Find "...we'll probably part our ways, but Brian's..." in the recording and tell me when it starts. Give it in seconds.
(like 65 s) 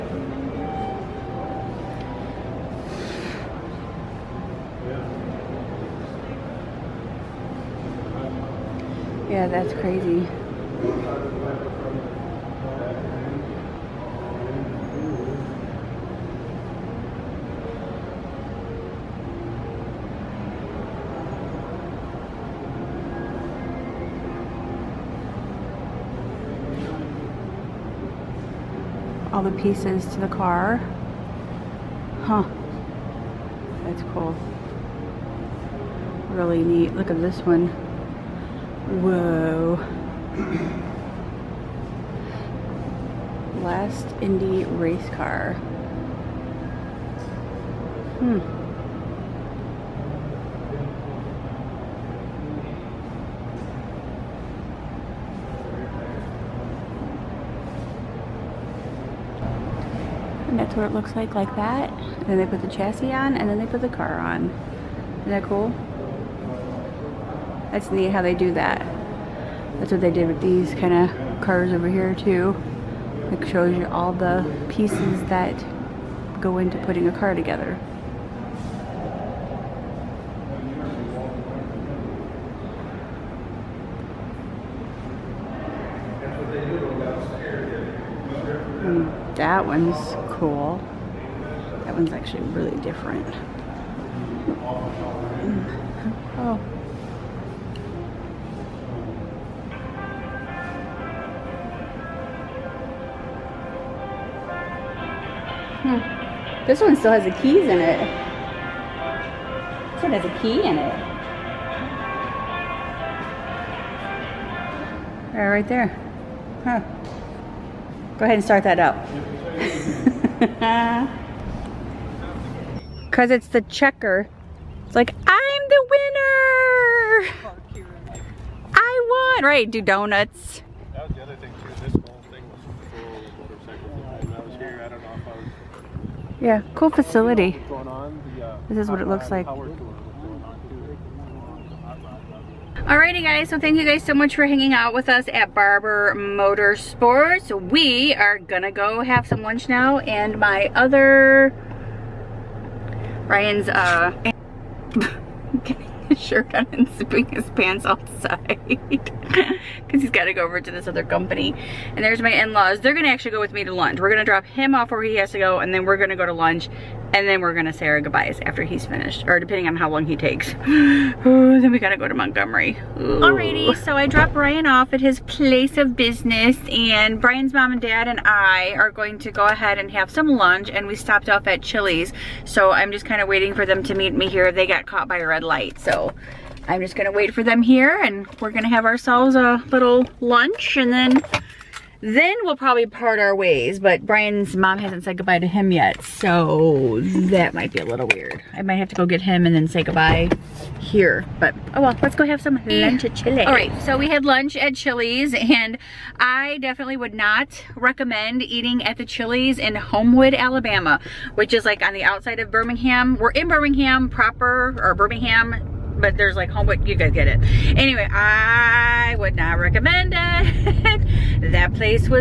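192 s.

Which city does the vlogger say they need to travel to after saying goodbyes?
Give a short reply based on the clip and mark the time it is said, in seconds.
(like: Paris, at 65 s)
Montgomery, at 172 s.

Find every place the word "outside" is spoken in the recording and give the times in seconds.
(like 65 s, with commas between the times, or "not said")
157 s, 212 s.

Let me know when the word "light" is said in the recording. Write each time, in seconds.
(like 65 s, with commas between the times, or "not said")
185 s.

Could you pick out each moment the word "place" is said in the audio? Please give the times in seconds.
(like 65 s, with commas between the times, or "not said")
175 s.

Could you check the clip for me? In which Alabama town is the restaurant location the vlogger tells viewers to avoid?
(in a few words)
Homewood.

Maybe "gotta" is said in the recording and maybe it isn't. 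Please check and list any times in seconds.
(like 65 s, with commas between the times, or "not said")
160 s, 171 s.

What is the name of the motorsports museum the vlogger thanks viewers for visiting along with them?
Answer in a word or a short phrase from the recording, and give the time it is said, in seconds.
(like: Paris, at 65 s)
Barber Motorsports, at 145 s.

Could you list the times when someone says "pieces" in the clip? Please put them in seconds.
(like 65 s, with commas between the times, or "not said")
29 s, 74 s.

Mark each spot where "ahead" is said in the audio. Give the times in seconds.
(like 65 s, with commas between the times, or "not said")
118 s, 179 s.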